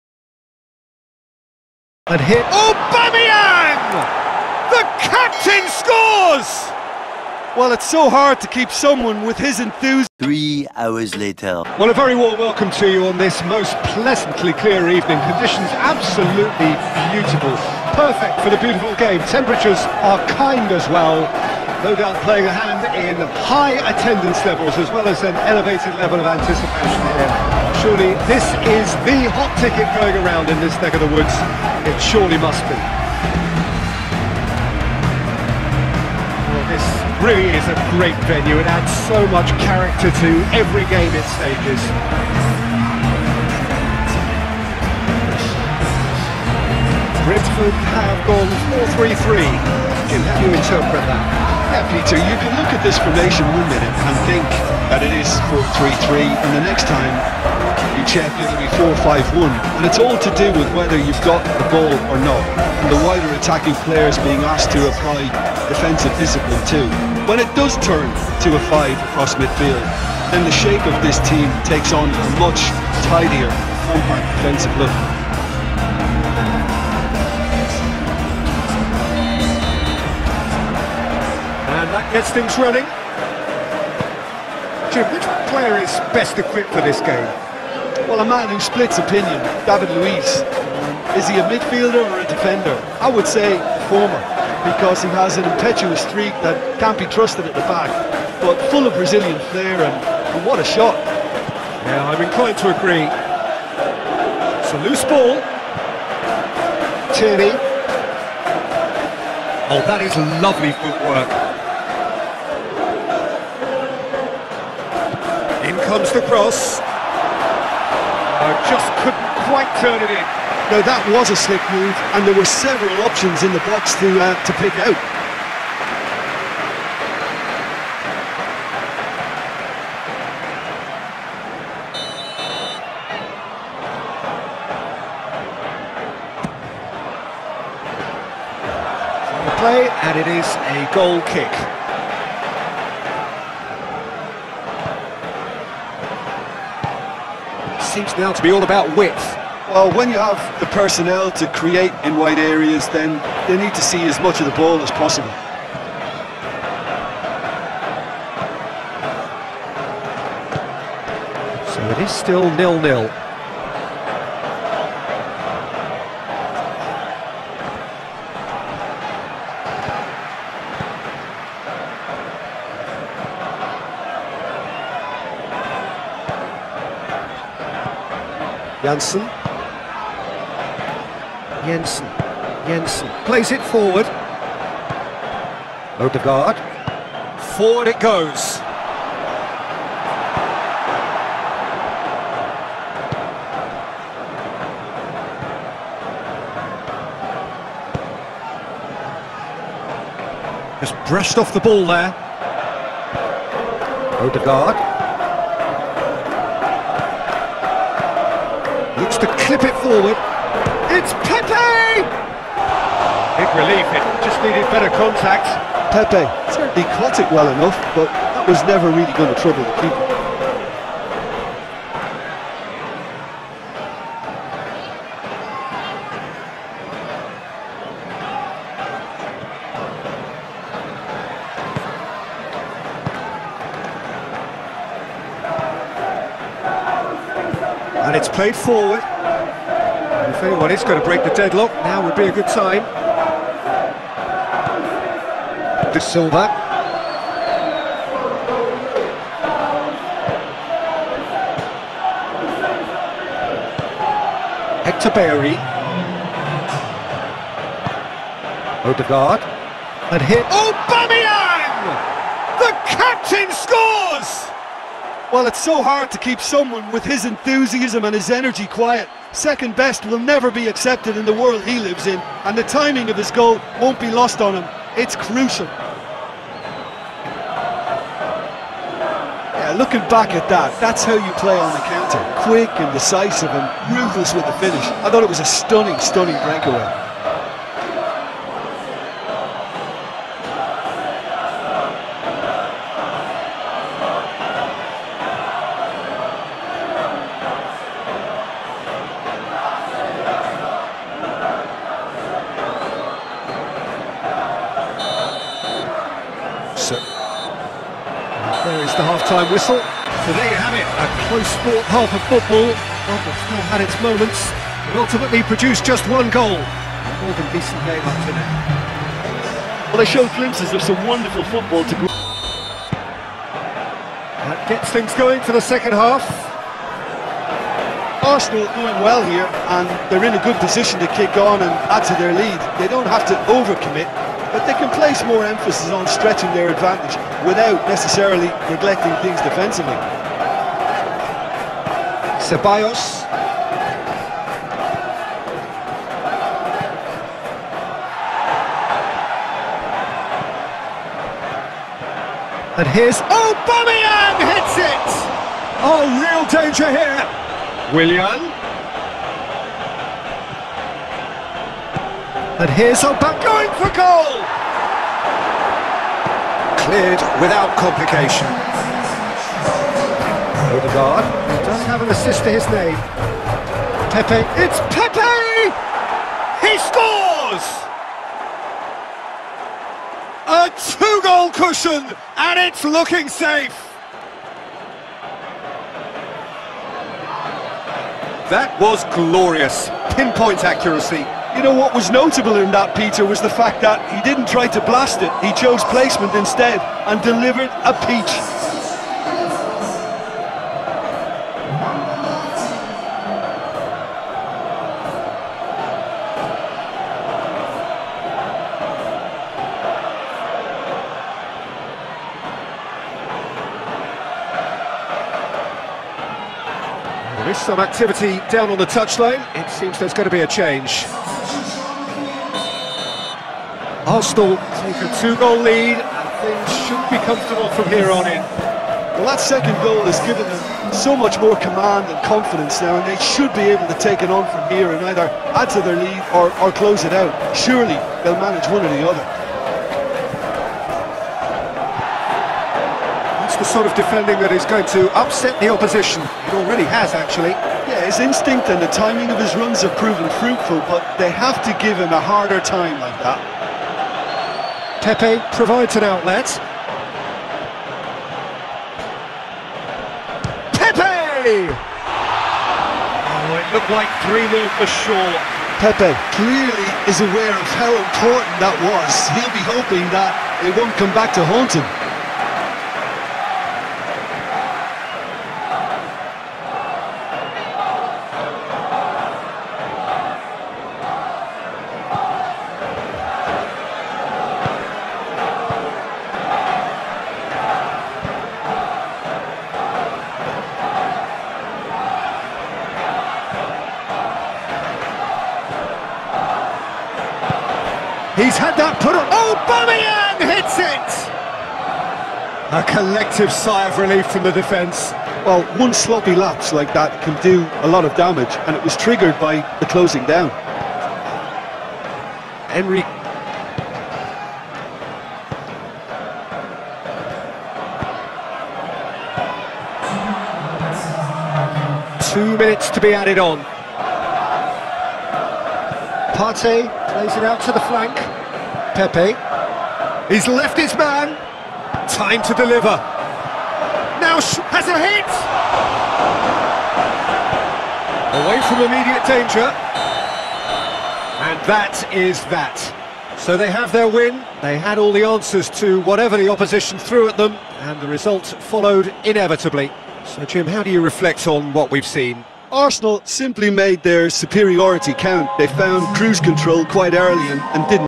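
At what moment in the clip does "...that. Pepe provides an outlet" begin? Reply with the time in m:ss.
7:33.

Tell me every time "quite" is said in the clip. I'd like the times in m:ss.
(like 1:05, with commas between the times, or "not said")
1:59, 9:16.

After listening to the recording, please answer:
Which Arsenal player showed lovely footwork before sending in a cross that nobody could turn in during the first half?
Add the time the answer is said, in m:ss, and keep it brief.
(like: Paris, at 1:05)
Tierney, at 1:47.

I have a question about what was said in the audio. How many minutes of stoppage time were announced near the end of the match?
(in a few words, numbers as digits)
2.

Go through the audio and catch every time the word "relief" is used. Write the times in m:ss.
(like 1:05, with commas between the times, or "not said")
3:33, 8:23.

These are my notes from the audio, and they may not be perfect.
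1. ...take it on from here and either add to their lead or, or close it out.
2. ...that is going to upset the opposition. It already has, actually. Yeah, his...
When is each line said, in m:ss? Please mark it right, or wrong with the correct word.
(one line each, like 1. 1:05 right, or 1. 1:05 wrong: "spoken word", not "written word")
1. 7:13 right
2. 7:24 right.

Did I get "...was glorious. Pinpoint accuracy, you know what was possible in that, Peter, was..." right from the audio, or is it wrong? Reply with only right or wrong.
wrong.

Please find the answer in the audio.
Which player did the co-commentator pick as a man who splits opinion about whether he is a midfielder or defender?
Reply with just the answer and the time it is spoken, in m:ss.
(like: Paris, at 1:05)
David Luiz, at 1:29.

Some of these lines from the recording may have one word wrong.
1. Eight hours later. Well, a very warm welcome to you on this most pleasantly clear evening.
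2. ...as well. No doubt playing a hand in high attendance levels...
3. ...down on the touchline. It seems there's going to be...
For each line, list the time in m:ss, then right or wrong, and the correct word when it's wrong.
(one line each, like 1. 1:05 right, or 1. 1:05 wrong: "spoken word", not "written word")
1. 0:10 wrong: "Three", not "Eight"
2. 0:20 right
3. 6:58 right.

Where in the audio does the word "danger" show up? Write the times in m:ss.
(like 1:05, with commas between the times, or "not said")
5:56, 8:59.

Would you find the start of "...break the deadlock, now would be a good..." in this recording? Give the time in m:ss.
4:01.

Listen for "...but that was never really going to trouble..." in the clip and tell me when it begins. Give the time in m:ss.
3:37.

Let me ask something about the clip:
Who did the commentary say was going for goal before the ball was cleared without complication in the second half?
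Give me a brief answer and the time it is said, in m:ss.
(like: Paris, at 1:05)
Opak, at 6:03.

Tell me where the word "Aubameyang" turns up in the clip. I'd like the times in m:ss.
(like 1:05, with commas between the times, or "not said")
0:02, 5:53, 8:19.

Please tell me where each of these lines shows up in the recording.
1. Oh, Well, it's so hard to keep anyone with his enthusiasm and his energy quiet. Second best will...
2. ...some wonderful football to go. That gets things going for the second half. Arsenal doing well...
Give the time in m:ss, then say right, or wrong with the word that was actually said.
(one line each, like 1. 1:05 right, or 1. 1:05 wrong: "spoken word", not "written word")
1. 4:20 wrong: "someone", not "anyone"
2. 5:20 right.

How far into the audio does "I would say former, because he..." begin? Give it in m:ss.
1:32.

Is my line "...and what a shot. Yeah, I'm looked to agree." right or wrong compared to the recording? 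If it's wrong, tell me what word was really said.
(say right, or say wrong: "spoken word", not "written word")
wrong: "inclined", not "looked".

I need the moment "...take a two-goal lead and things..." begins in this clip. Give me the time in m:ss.
7:04.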